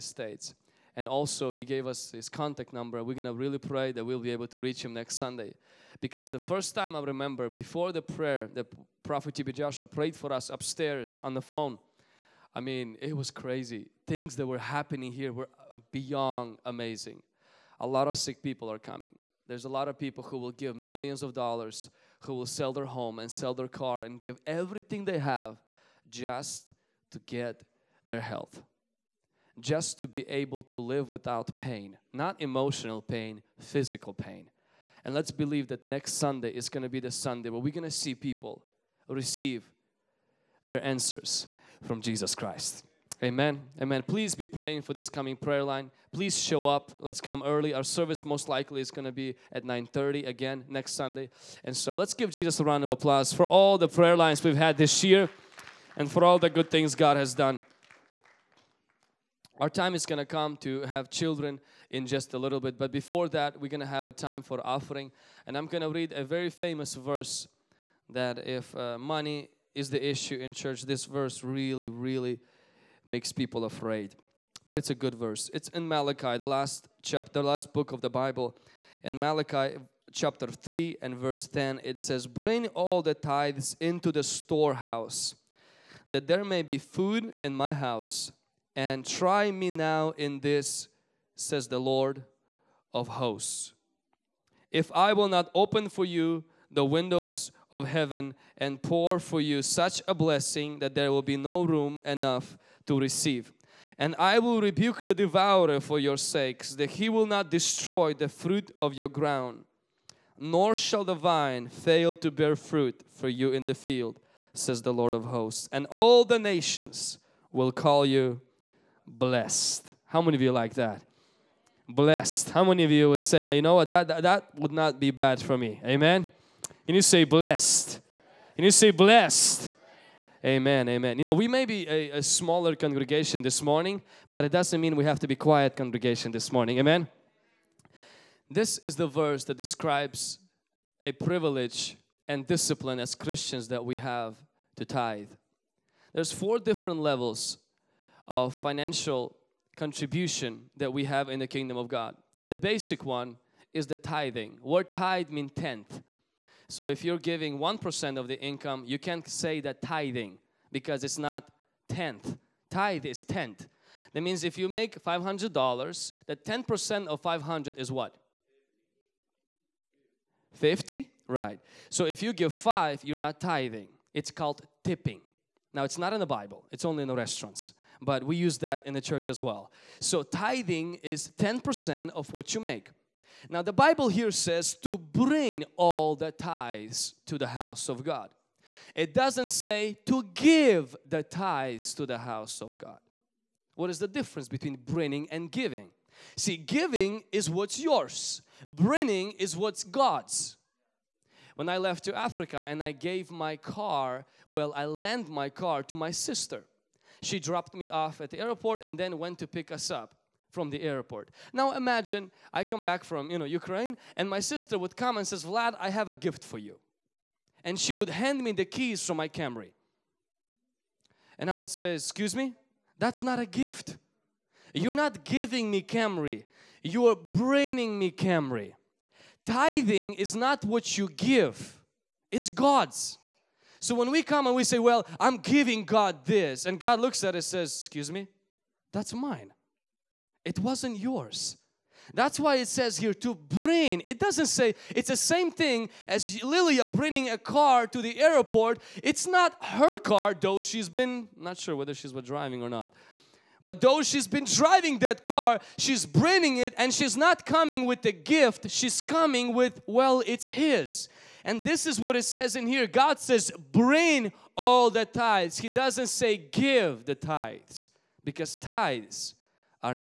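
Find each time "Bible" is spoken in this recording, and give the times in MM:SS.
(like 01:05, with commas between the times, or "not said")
01:18, 02:56, 03:03.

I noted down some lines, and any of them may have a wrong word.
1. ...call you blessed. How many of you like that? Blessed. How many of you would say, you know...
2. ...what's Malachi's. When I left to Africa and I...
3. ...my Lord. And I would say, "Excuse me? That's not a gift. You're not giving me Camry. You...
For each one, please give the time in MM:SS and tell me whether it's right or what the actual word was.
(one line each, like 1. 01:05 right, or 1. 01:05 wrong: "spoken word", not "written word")
1. 01:57 right
2. 03:19 wrong: "God", not "Malachi"
3. 03:39 wrong: "Camry", not "Lord".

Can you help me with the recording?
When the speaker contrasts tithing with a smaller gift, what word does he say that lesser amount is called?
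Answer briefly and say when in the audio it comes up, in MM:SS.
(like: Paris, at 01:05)
Tipping, at 02:54.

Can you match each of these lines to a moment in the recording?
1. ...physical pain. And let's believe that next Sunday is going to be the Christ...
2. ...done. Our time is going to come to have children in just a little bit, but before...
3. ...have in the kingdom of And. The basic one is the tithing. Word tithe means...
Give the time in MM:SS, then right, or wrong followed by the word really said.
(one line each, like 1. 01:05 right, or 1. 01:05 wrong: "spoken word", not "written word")
1. 00:33 wrong: "Sunday", not "Christ"
2. 00:57 right
3. 02:31 wrong: "God", not "And".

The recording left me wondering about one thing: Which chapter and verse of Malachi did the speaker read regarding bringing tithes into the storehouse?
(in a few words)
Chapter 3 verse 10.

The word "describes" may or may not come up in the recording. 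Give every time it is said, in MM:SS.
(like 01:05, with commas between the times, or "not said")
02:19.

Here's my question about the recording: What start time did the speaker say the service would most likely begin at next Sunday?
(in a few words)
9:30.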